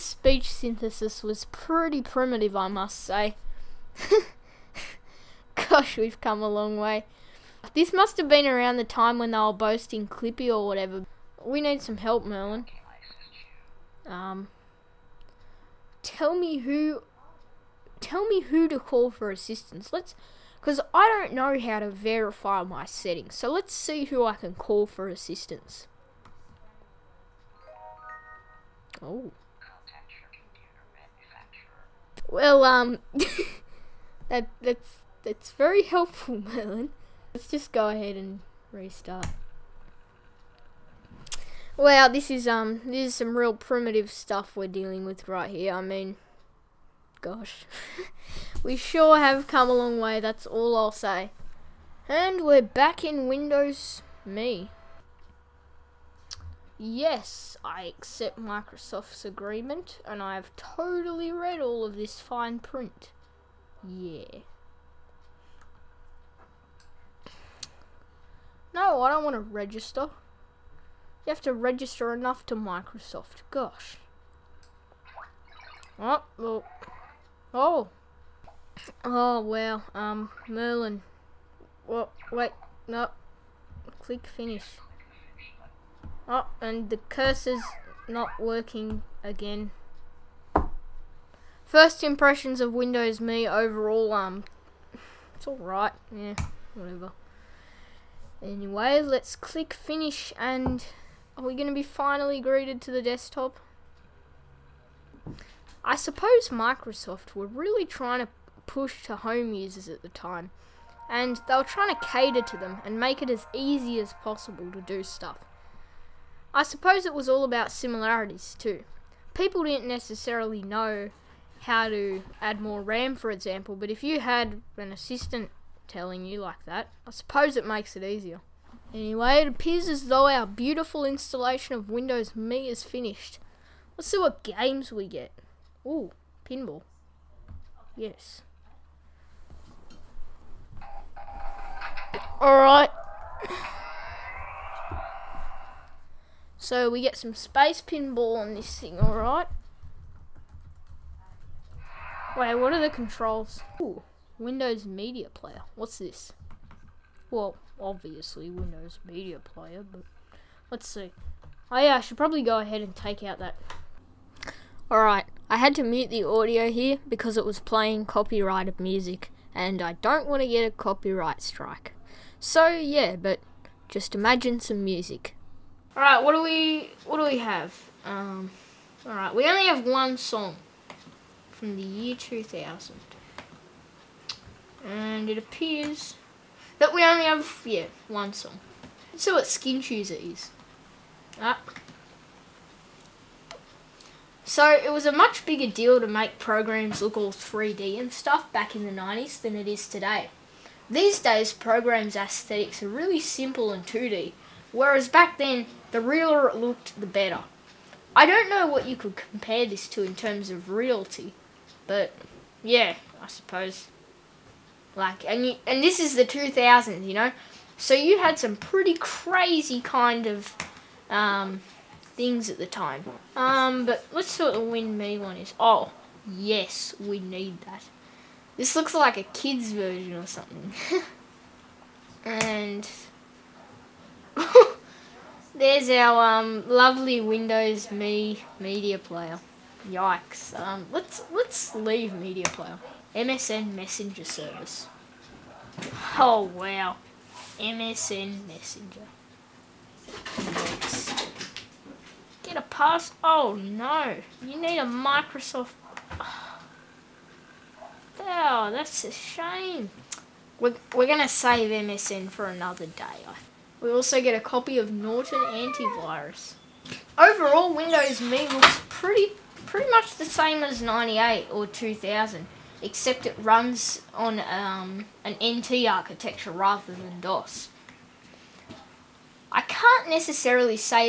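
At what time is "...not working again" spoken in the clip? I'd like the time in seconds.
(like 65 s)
88 s.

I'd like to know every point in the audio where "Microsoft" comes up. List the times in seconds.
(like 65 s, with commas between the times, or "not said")
58 s, 72 s, 106 s, 254 s.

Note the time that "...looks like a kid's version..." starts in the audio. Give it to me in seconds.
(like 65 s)
228 s.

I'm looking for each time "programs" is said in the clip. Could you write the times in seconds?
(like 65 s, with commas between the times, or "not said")
196 s, 201 s.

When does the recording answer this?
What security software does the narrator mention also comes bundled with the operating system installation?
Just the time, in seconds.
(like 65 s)
264 s.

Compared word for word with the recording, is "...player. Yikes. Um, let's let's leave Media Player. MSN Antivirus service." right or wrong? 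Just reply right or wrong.
wrong.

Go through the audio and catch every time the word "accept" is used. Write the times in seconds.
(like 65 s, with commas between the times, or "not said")
57 s.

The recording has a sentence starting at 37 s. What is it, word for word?
Let's just go ahead and restart.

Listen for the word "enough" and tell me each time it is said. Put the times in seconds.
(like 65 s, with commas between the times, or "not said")
72 s.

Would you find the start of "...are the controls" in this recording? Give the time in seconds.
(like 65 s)
152 s.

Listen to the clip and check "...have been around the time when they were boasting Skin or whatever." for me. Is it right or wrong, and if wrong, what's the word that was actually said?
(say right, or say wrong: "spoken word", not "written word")
wrong: "Clippy", not "Skin".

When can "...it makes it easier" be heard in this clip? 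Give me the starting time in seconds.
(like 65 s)
127 s.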